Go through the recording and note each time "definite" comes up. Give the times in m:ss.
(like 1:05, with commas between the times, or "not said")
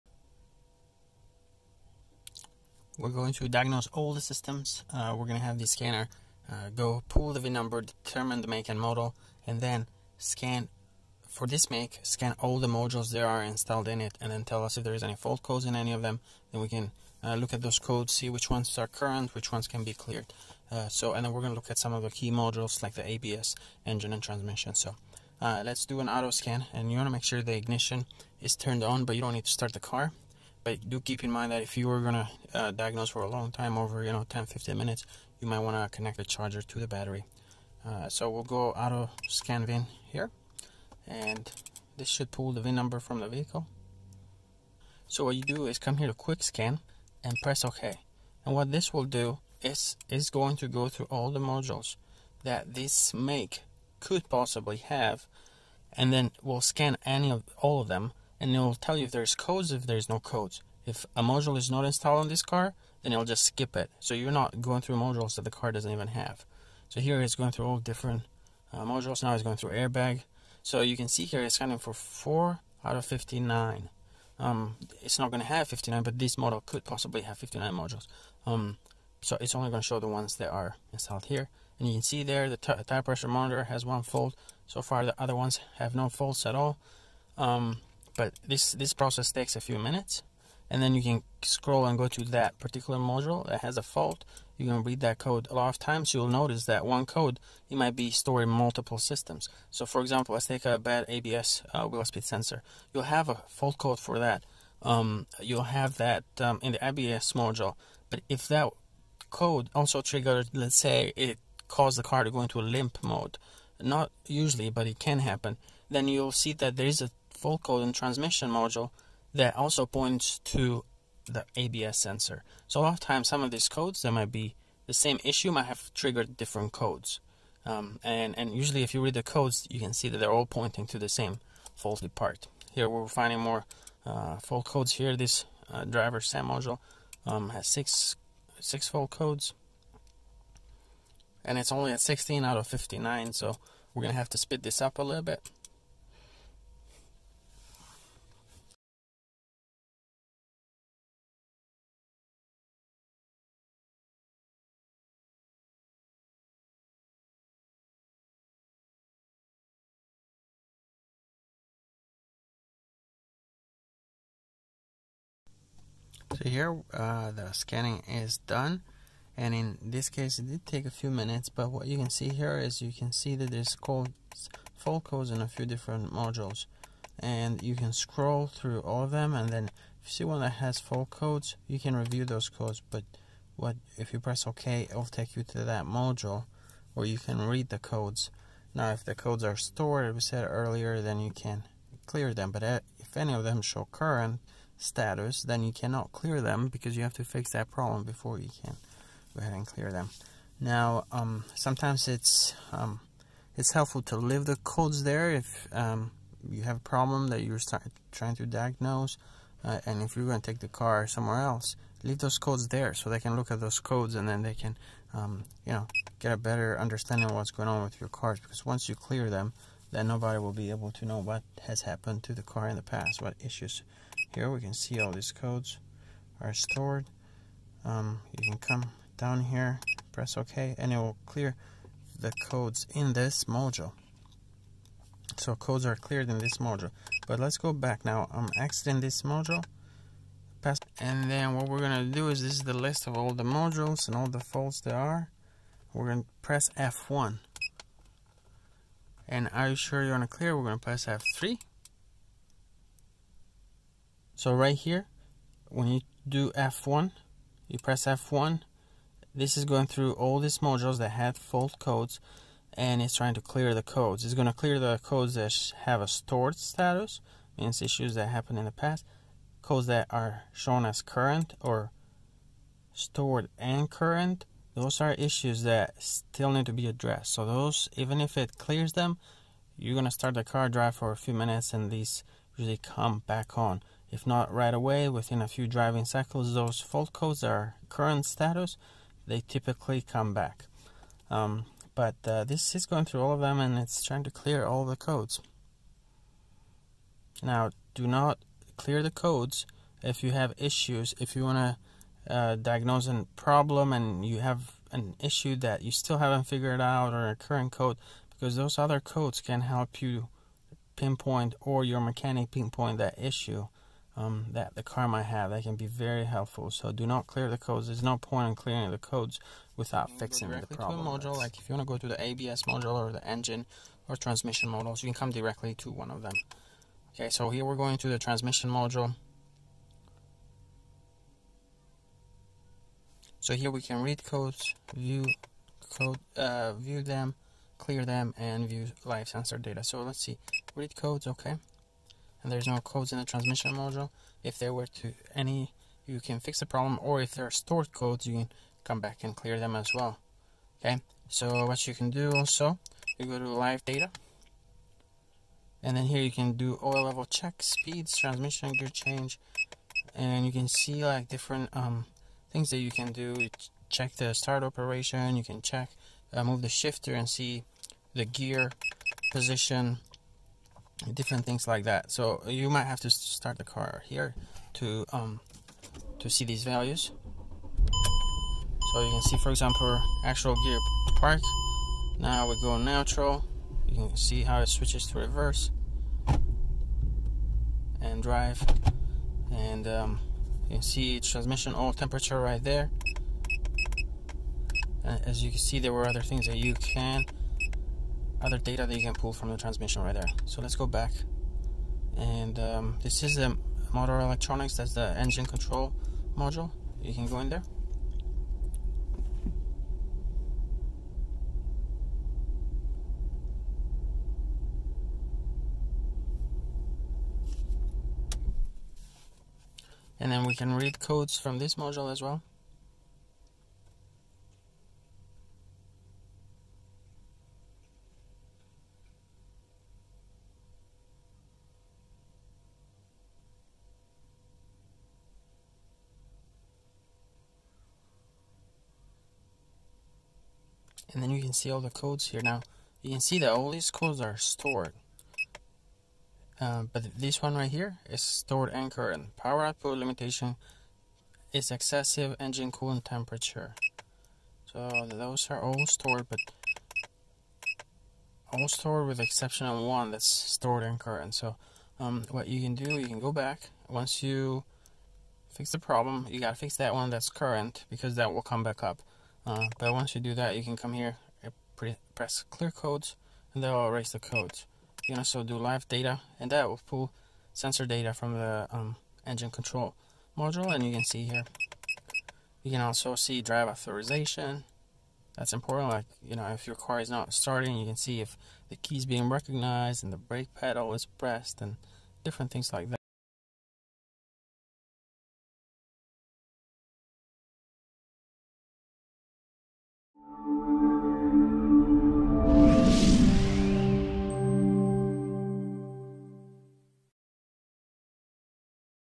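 not said.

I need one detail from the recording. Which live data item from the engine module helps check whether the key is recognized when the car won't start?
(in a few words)
drive authorization.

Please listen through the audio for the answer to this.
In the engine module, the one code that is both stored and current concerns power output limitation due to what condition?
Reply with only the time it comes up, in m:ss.
7:31.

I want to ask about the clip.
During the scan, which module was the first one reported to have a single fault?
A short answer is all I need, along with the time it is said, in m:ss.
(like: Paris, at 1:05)
tire pressure monitor, at 1:22.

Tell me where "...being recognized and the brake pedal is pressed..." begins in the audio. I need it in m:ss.
8:09.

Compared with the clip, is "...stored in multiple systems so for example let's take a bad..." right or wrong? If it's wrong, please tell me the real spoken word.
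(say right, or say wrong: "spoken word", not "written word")
right.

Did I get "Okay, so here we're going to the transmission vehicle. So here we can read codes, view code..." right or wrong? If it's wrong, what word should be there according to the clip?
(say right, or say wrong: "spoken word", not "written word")
wrong: "module", not "vehicle".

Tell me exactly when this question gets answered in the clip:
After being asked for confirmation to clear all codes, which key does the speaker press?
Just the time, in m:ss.
4:11.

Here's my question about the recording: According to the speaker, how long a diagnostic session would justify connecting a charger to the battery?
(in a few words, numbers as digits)
10-15 minutes.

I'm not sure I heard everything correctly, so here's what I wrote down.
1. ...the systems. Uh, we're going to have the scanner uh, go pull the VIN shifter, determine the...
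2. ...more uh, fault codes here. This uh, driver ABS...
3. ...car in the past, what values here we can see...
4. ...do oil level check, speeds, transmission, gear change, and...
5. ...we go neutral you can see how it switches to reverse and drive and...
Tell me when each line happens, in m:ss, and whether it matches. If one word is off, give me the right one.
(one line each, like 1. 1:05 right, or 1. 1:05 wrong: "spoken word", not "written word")
1. 0:04 wrong: "number", not "shifter"
2. 2:13 wrong: "SAM", not "ABS"
3. 3:42 wrong: "issues", not "values"
4. 5:56 right
5. 6:22 right.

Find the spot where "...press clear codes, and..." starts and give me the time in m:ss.
7:52.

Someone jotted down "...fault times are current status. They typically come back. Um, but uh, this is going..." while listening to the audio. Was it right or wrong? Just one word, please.
wrong.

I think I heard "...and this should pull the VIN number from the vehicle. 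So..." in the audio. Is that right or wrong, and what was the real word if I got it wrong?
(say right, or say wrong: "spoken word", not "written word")
right.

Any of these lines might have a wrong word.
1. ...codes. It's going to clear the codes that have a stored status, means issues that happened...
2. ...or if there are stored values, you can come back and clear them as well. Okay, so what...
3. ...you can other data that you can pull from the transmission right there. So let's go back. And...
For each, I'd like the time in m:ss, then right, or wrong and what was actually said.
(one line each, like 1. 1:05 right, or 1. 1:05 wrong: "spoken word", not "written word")
1. 4:23 right
2. 5:47 wrong: "codes", not "values"
3. 6:36 right.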